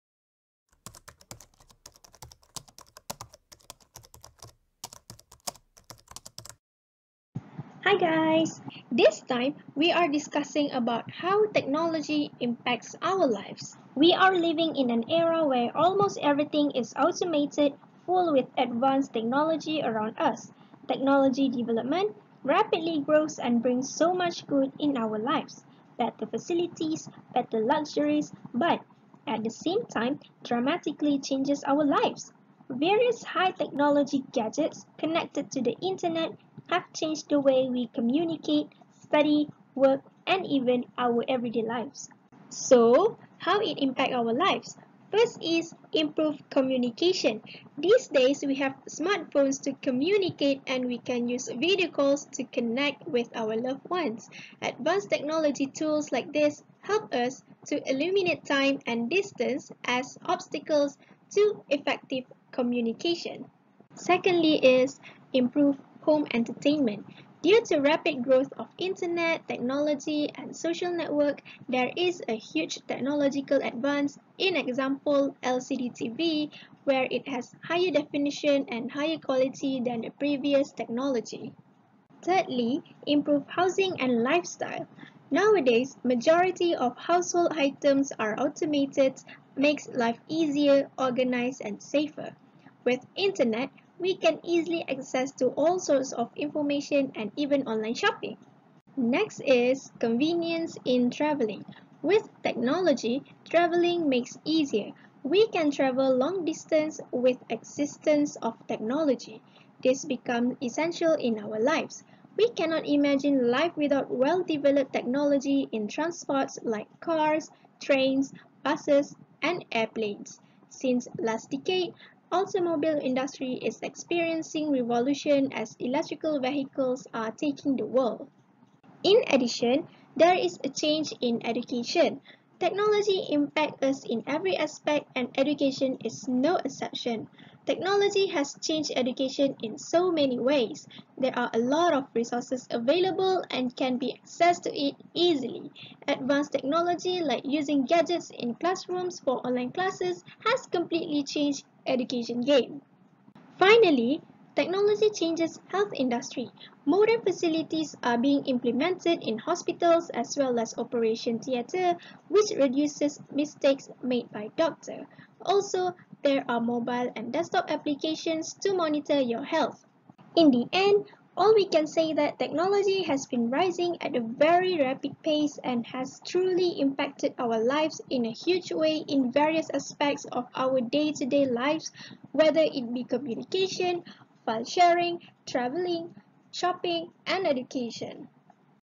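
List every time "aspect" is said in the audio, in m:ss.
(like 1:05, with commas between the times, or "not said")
2:14, 2:59.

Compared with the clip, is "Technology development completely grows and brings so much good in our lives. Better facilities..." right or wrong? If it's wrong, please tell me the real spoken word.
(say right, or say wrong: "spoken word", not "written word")
wrong: "rapidly", not "completely".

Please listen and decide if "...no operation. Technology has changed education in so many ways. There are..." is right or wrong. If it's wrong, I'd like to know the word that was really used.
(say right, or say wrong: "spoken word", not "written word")
wrong: "exception", not "operation".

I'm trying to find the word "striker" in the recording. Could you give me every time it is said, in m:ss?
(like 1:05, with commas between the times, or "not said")
not said.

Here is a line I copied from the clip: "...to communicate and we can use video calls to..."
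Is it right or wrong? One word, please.
right.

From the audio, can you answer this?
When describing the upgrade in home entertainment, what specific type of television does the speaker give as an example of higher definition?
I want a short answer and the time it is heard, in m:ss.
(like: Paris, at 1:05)
LCD TV, at 1:15.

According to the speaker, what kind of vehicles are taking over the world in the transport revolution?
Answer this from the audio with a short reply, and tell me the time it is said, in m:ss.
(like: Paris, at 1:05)
electrical vehicles, at 2:05.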